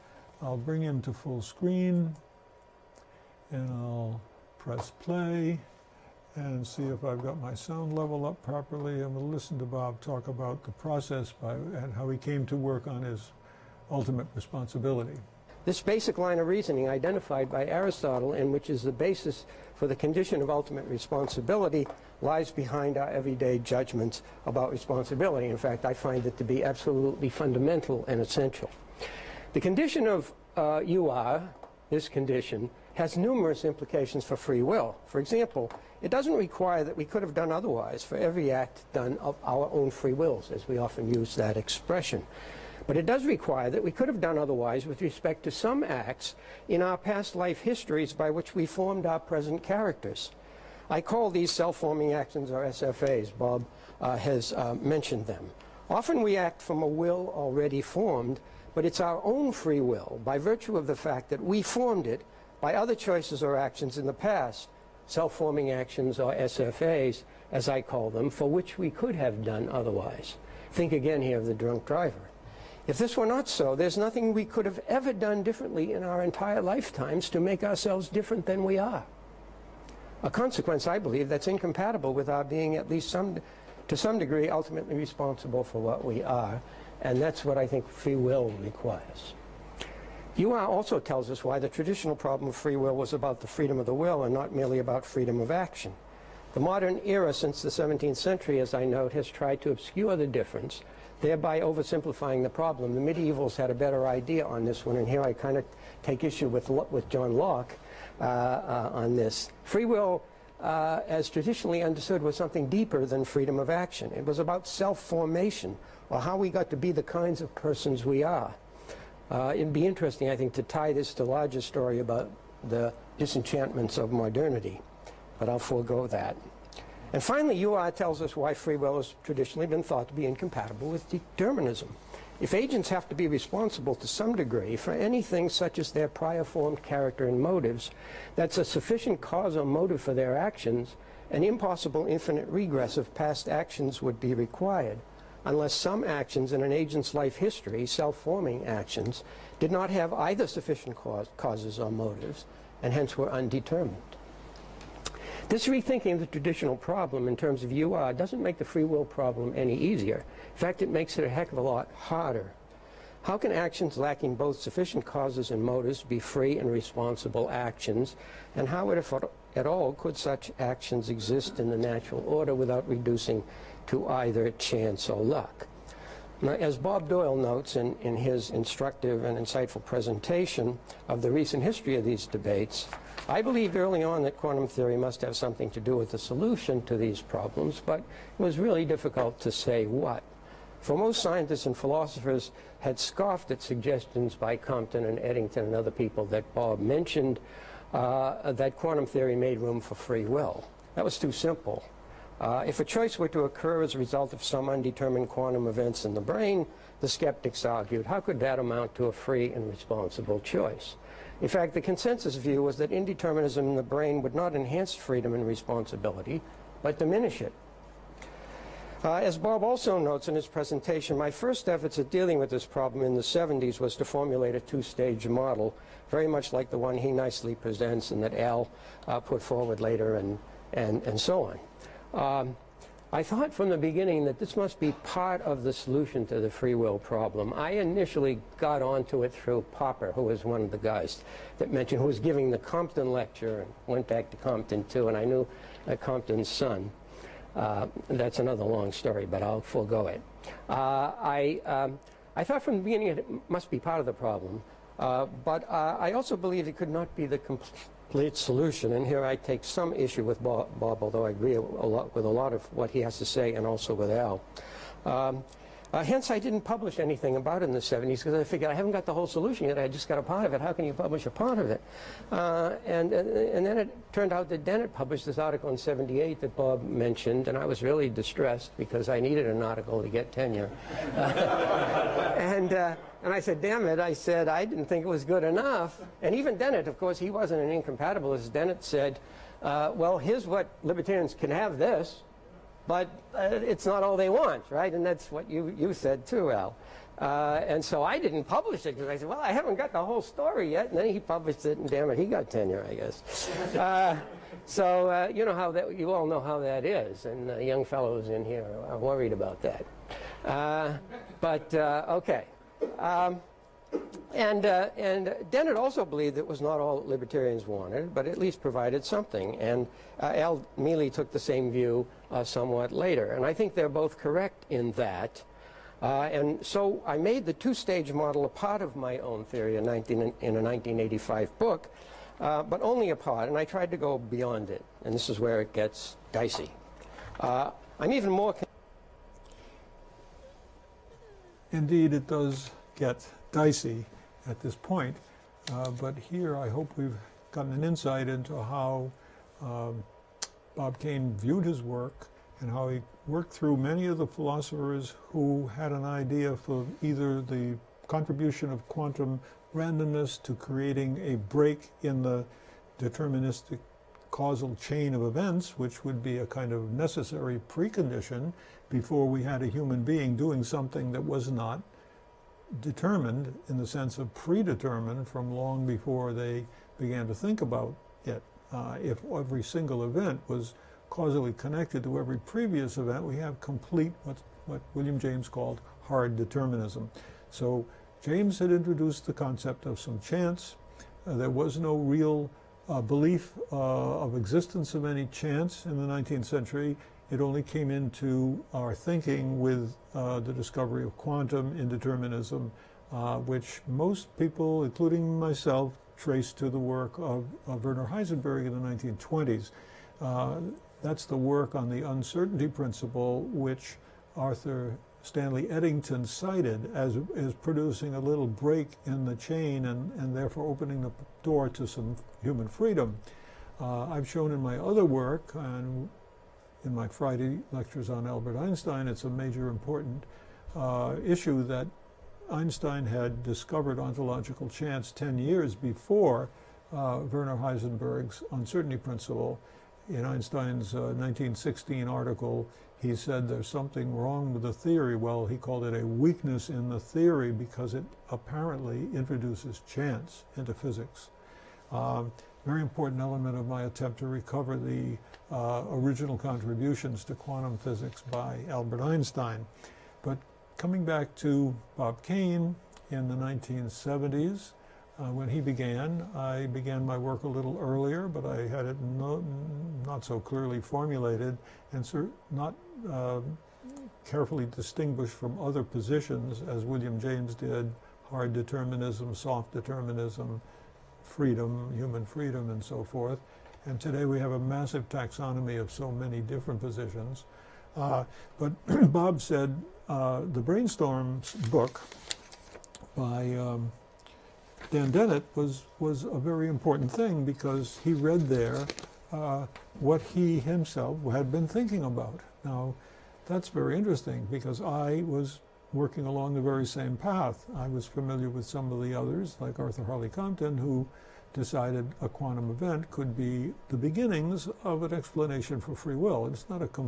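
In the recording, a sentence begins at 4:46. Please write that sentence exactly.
And even Dennett, of course, he wasn't an incompatibilist.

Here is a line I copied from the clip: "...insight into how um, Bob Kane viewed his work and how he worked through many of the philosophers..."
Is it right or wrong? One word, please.
right.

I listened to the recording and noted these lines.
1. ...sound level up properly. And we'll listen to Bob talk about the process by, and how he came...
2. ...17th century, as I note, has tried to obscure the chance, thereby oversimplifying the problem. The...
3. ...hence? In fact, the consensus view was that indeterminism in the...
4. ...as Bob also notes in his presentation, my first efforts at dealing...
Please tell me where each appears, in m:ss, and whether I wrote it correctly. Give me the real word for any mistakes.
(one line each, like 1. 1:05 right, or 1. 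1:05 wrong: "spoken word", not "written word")
1. 0:07 right
2. 1:37 wrong: "difference", not "chance"
3. 3:30 wrong: "choice", not "hence"
4. 3:39 right.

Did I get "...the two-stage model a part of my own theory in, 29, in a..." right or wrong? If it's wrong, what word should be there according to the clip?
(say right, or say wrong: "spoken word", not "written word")
wrong: "19", not "29".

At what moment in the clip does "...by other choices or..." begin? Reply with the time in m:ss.
1:02.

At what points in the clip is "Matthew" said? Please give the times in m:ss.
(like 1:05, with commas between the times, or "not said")
not said.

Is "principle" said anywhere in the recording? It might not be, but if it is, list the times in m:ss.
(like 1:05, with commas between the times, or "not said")
6:52, 7:18.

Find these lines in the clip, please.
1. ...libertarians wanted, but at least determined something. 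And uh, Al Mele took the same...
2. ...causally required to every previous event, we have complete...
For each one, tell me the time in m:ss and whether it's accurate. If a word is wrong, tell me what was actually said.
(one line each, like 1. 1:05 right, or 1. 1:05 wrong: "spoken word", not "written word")
1. 5:17 wrong: "provided", not "determined"
2. 6:21 wrong: "connected", not "required".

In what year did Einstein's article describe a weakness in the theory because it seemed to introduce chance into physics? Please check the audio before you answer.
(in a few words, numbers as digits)
1916.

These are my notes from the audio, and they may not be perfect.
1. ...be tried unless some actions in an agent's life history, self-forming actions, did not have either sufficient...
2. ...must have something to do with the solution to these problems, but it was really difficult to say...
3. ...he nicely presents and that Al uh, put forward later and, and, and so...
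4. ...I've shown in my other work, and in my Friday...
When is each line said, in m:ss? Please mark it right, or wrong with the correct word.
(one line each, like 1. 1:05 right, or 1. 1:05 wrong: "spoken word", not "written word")
1. 2:24 wrong: "required", not "tried"
2. 3:04 right
3. 3:46 right
4. 7:04 right.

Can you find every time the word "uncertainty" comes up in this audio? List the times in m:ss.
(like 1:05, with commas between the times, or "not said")
6:52, 7:18.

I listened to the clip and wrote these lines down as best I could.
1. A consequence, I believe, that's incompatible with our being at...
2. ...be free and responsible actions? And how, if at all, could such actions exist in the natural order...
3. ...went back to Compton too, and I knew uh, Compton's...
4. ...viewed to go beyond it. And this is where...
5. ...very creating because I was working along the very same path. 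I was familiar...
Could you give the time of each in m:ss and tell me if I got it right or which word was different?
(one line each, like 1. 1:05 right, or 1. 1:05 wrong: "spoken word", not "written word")
1. 1:20 right
2. 2:46 right
3. 4:03 right
4. 5:33 wrong: "tried", not "viewed"
5. 8:23 wrong: "interesting", not "creating".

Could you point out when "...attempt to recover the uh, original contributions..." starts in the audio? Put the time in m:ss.
7:33.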